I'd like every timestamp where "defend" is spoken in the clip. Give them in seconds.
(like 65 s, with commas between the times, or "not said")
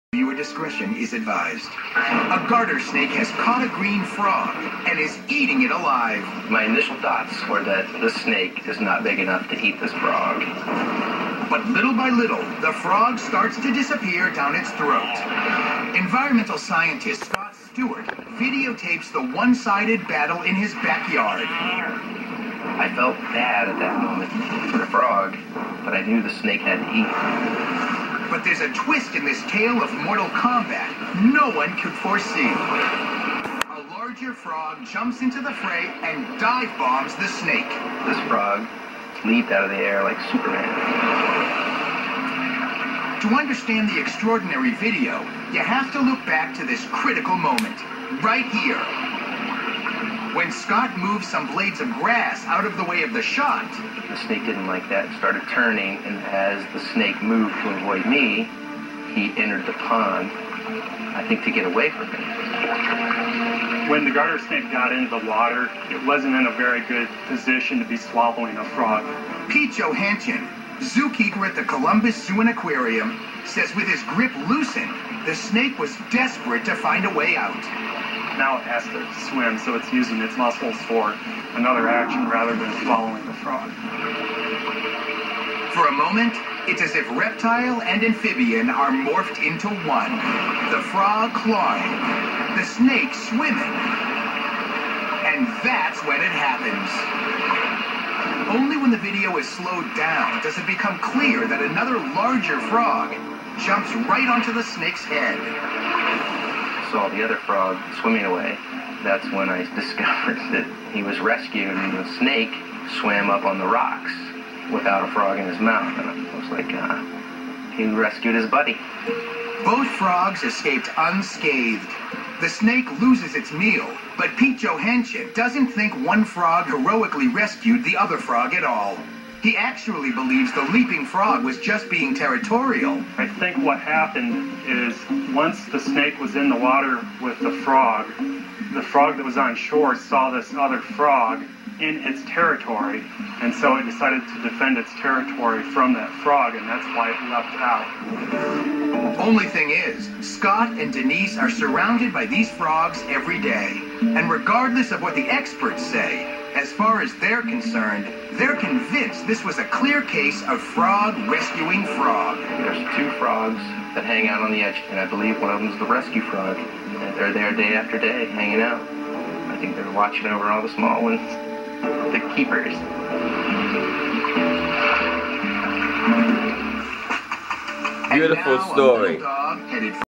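144 s.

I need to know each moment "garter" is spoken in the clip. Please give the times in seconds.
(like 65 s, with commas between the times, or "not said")
2 s, 64 s.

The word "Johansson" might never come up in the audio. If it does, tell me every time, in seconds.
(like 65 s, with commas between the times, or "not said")
69 s, 124 s.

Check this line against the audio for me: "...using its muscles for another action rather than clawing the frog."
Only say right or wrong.
wrong.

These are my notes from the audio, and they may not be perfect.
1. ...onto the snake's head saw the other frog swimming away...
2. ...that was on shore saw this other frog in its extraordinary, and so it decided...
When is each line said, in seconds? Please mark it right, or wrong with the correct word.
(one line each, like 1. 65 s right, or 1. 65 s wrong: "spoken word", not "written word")
1. 104 s right
2. 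139 s wrong: "territory", not "extraordinary".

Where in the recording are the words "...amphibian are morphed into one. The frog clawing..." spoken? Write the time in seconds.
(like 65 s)
88 s.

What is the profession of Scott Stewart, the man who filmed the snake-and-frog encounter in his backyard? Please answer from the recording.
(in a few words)
Environmental scientist.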